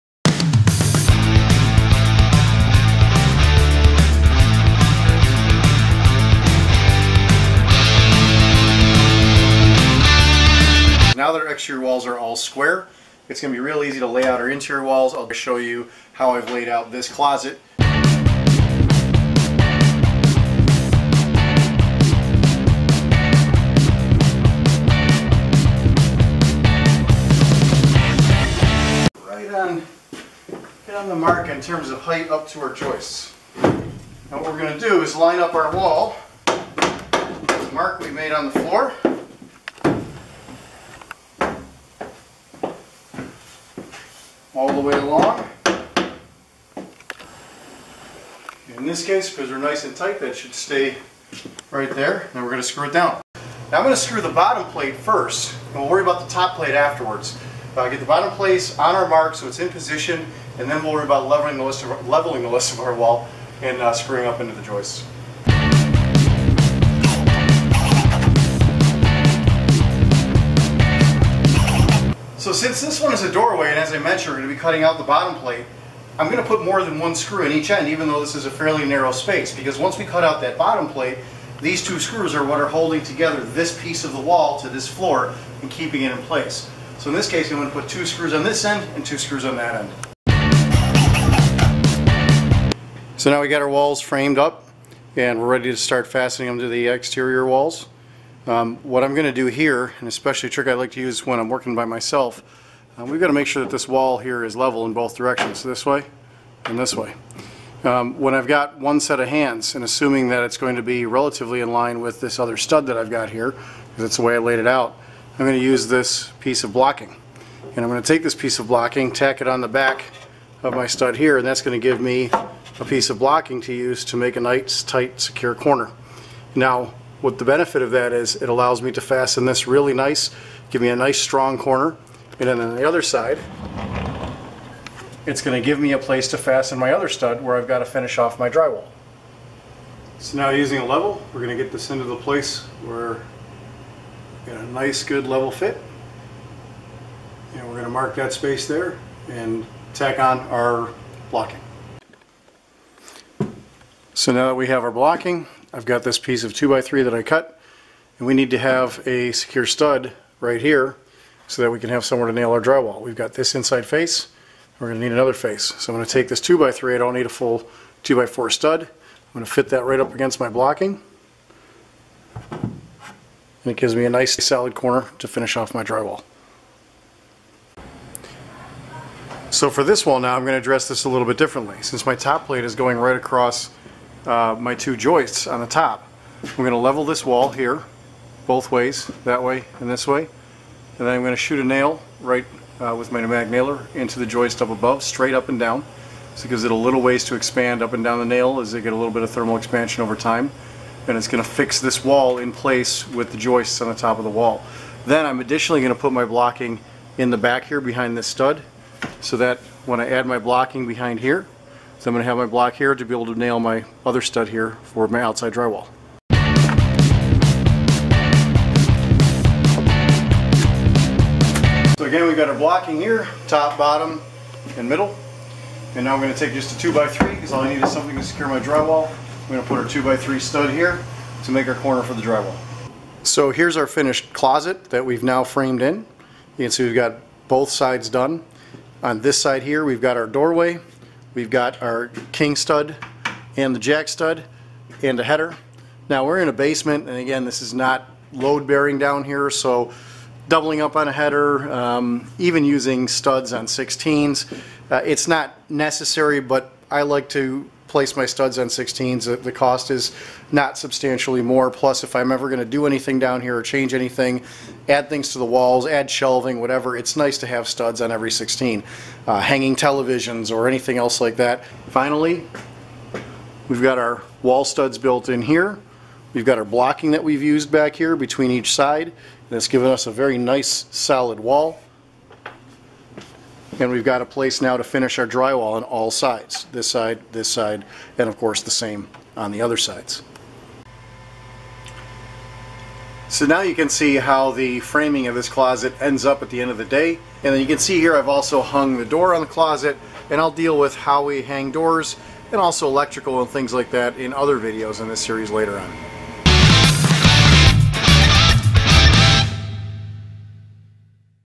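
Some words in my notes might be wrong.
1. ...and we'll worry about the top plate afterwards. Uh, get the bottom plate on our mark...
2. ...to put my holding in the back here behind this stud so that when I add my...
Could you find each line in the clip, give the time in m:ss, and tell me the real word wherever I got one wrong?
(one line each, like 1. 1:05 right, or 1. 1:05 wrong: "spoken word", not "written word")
1. 0:55 right
2. 3:25 wrong: "blocking", not "holding".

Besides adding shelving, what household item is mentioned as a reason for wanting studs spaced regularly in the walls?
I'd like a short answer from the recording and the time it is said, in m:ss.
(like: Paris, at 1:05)
televisions, at 4:29.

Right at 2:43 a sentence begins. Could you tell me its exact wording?
We've got this inside face, we're going to need another face.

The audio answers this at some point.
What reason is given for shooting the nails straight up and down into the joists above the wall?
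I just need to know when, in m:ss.
3:19.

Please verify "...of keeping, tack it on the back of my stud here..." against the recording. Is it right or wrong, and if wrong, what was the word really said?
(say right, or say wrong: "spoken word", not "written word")
wrong: "blocking", not "keeping".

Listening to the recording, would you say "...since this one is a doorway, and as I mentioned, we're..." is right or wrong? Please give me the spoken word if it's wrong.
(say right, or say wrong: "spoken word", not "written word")
right.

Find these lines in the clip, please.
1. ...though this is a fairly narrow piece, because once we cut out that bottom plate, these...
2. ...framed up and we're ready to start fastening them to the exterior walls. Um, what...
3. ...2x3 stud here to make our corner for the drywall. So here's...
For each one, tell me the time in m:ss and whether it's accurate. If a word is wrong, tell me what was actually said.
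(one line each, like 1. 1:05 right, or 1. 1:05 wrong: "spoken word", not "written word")
1. 1:18 wrong: "space", not "piece"
2. 1:34 right
3. 3:49 right.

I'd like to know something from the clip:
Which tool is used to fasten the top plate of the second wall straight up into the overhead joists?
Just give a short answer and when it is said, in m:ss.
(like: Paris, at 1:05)
pneumatic nailer, at 3:13.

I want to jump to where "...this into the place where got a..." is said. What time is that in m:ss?
2:21.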